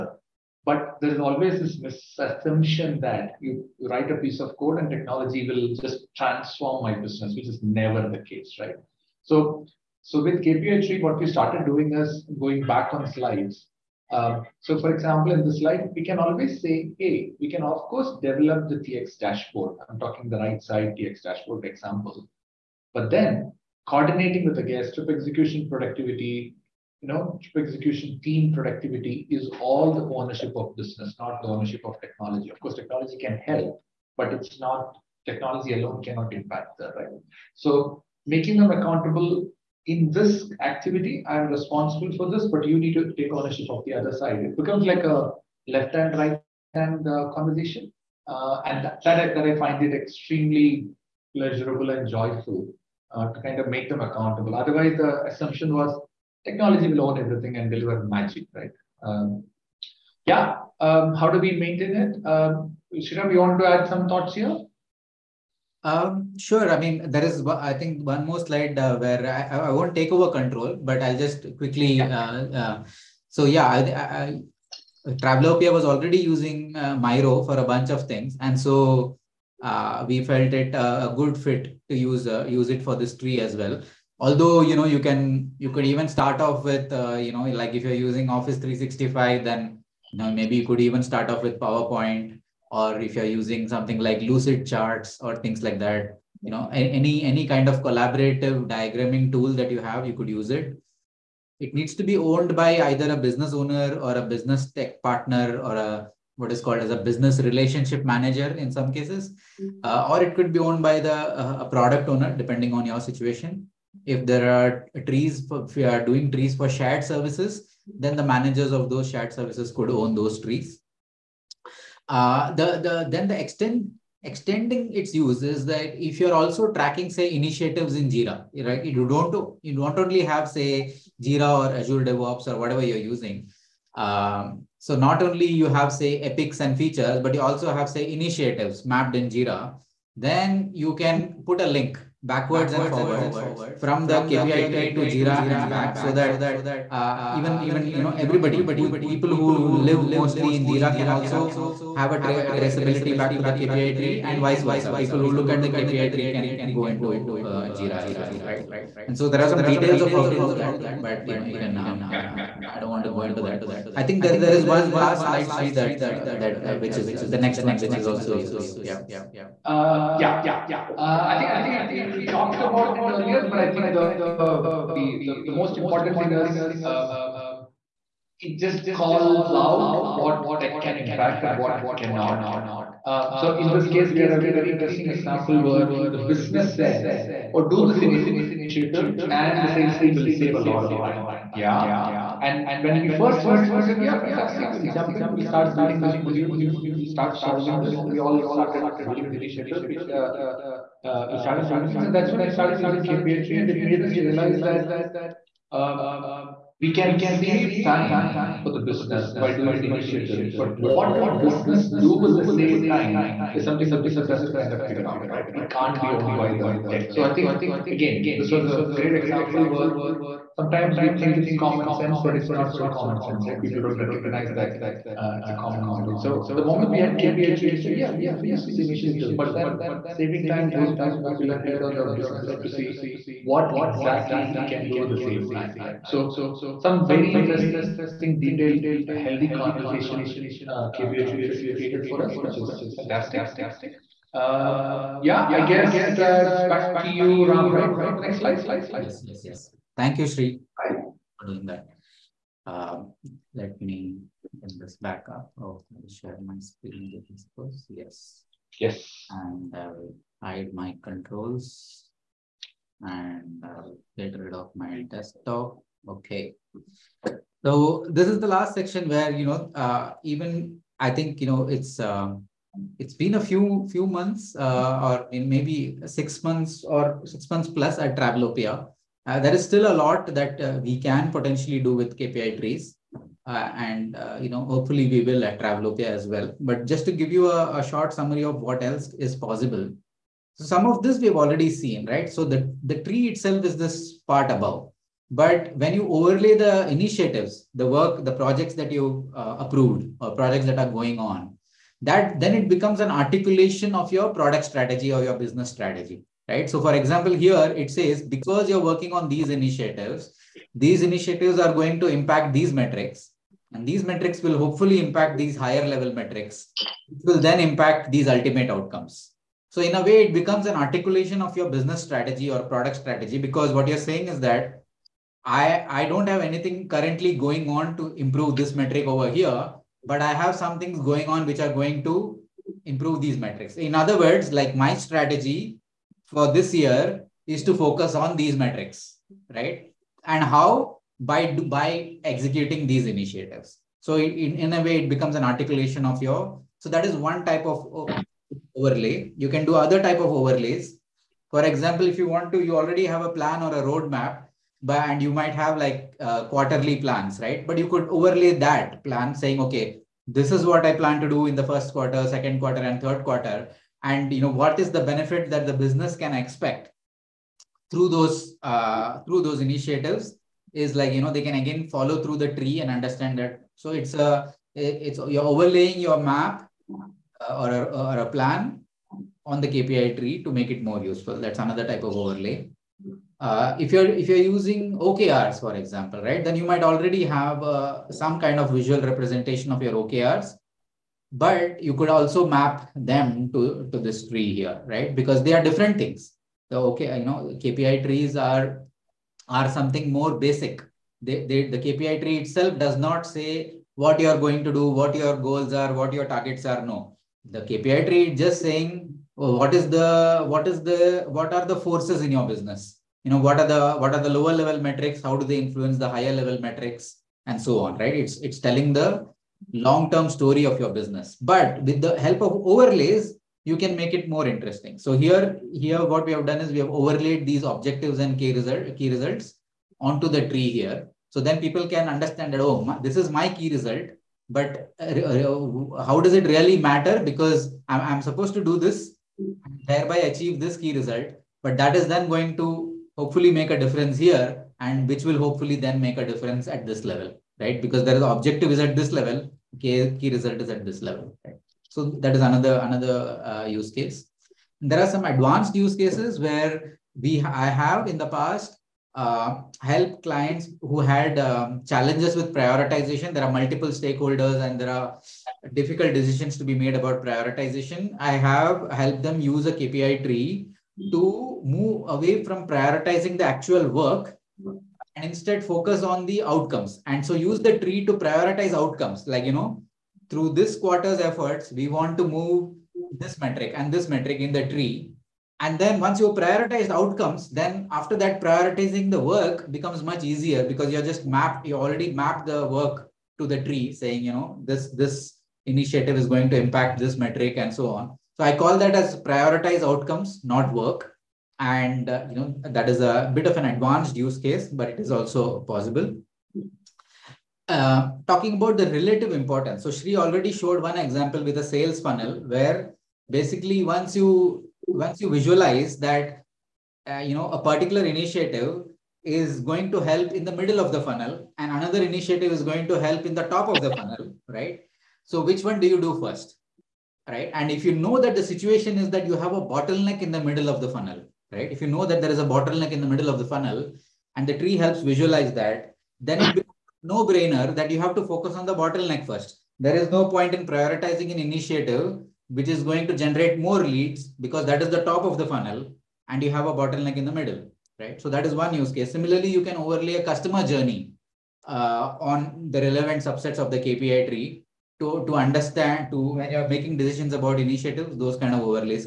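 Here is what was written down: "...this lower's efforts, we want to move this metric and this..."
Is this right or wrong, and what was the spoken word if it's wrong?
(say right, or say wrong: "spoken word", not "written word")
wrong: "quarter", not "lower".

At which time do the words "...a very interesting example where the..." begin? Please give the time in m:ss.
3:04.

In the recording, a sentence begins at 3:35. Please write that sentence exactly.
It can't be owned by the tech.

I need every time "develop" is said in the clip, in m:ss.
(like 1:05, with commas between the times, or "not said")
0:18.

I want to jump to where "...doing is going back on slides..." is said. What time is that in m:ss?
0:11.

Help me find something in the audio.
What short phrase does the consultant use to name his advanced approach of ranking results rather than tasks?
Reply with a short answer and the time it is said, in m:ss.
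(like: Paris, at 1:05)
Prioritize outcomes, not work, at 8:19.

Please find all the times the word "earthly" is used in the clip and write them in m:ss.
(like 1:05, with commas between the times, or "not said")
not said.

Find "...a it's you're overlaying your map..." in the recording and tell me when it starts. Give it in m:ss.
6:14.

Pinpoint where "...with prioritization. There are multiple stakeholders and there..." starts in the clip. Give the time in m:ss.
7:42.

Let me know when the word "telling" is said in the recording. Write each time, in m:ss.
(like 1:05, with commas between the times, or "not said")
6:58.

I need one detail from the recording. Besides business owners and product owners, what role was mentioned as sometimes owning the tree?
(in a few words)
Business relationship manager.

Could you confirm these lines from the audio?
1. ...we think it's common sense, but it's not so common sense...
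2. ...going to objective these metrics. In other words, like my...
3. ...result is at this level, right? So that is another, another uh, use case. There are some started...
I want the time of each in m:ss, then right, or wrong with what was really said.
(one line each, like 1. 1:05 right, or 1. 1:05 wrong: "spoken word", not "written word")
1. 3:40 right
2. 5:31 wrong: "improve", not "objective"
3. 7:30 wrong: "advanced", not "started".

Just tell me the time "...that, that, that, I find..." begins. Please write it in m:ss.
0:48.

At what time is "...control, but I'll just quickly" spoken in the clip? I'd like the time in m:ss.
1:10.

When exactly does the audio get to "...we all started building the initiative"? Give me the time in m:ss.
3:18.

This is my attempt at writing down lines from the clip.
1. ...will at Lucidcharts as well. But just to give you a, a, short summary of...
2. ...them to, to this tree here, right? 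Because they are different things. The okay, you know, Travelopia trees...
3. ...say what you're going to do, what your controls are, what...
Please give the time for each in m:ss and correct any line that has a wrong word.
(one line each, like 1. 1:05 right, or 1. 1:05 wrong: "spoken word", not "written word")
1. 4:45 wrong: "Travelopia", not "Lucidcharts"
2. 6:32 wrong: "KPI", not "Travelopia"
3. 6:43 wrong: "goals", not "controls".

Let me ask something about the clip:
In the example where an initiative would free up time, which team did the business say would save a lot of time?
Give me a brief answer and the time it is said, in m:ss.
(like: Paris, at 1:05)
Sales team, at 3:09.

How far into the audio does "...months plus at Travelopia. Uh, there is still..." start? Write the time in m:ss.
4:37.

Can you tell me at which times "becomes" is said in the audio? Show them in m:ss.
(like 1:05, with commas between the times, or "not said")
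0:44, 5:02, 5:20, 5:45, 8:09, 8:56.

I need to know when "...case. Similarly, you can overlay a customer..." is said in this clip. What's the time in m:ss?
9:08.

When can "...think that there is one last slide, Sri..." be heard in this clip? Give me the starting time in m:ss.
2:44.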